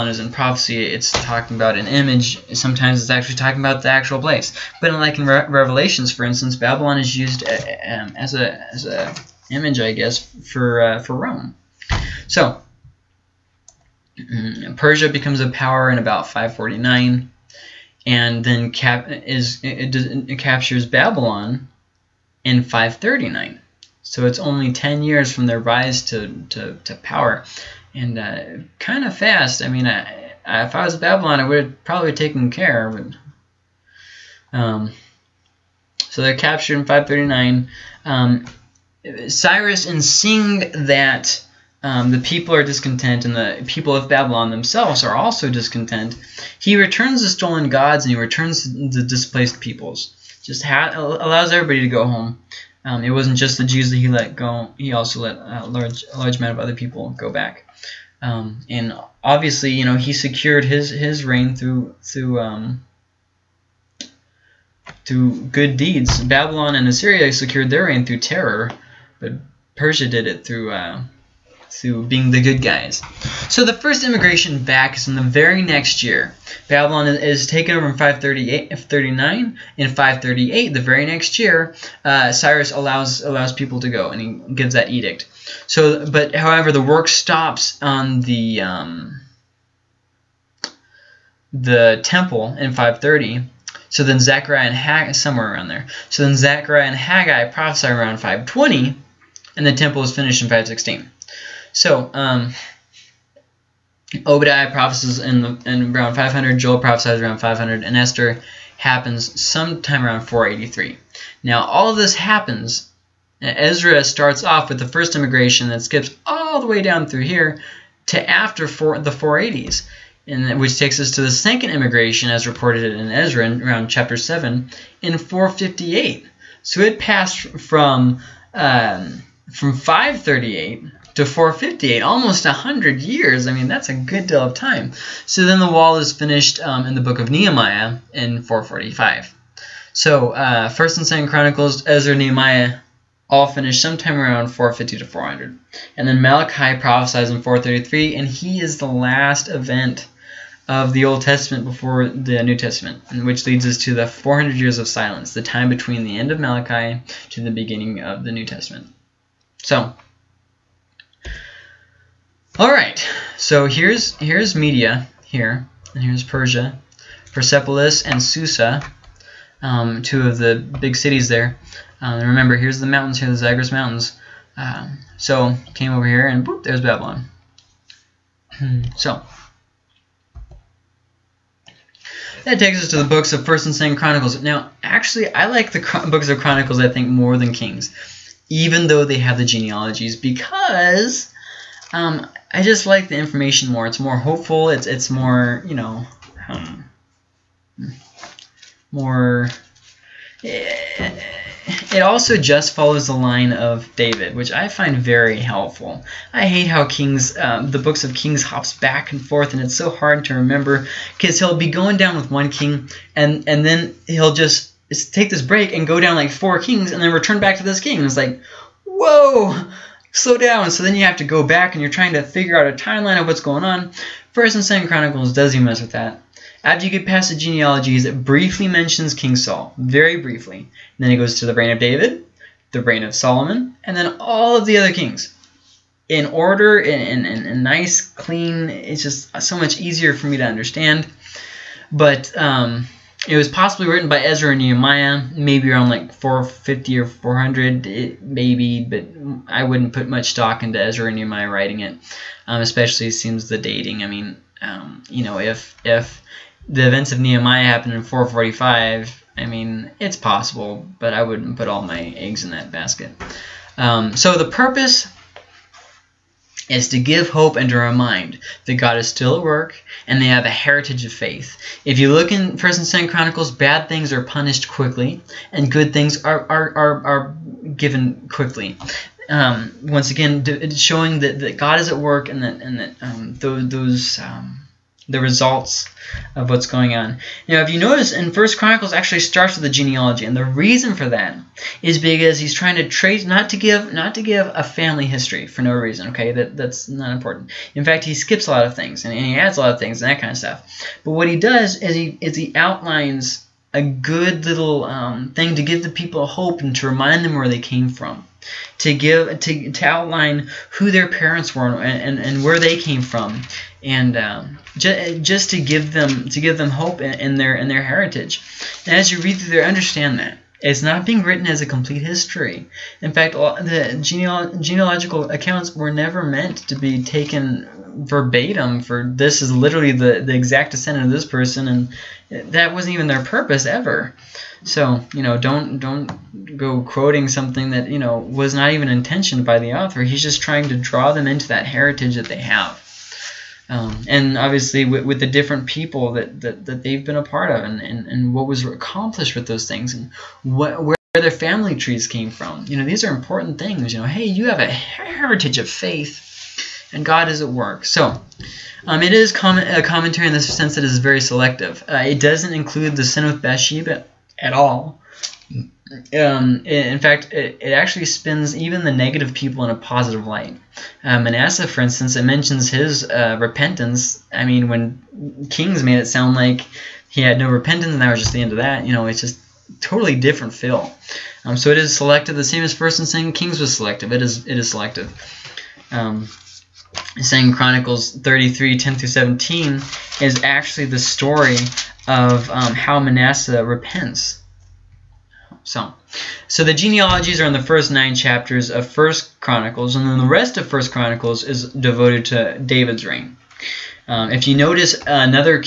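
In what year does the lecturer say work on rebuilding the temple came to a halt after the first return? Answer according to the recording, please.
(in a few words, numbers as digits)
530.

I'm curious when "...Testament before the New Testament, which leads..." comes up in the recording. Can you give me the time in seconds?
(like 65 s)
151 s.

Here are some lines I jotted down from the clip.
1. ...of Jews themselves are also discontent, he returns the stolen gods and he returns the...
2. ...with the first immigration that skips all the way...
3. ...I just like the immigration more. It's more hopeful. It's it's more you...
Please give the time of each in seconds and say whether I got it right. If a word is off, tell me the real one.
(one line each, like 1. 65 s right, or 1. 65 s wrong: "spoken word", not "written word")
1. 43 s wrong: "Babylon", not "Jews"
2. 114 s right
3. 192 s wrong: "information", not "immigration".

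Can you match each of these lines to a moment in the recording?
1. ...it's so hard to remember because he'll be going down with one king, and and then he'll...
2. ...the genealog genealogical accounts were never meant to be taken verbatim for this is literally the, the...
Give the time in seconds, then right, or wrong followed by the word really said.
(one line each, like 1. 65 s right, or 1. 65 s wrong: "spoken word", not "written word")
1. 209 s right
2. 323 s right.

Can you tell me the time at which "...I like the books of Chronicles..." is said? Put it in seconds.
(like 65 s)
185 s.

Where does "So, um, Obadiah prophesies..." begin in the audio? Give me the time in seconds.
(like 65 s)
101 s.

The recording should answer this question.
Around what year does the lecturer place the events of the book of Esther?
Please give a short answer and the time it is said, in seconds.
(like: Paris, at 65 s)
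483, at 110 s.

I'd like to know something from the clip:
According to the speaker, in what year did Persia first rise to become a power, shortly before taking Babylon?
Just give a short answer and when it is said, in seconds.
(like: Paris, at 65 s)
549, at 16 s.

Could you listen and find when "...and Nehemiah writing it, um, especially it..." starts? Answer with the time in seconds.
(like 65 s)
251 s.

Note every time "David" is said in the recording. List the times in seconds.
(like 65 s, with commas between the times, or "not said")
203 s, 231 s, 402 s.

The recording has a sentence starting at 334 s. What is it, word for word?
So you know, don't don't go quoting something that you know was not even intentioned by the author.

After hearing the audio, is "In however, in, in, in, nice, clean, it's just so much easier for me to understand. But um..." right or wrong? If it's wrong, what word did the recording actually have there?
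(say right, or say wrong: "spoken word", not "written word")
wrong: "order", not "however".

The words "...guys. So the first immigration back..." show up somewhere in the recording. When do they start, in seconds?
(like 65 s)
72 s.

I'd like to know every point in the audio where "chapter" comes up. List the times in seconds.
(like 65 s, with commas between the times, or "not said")
123 s, 398 s.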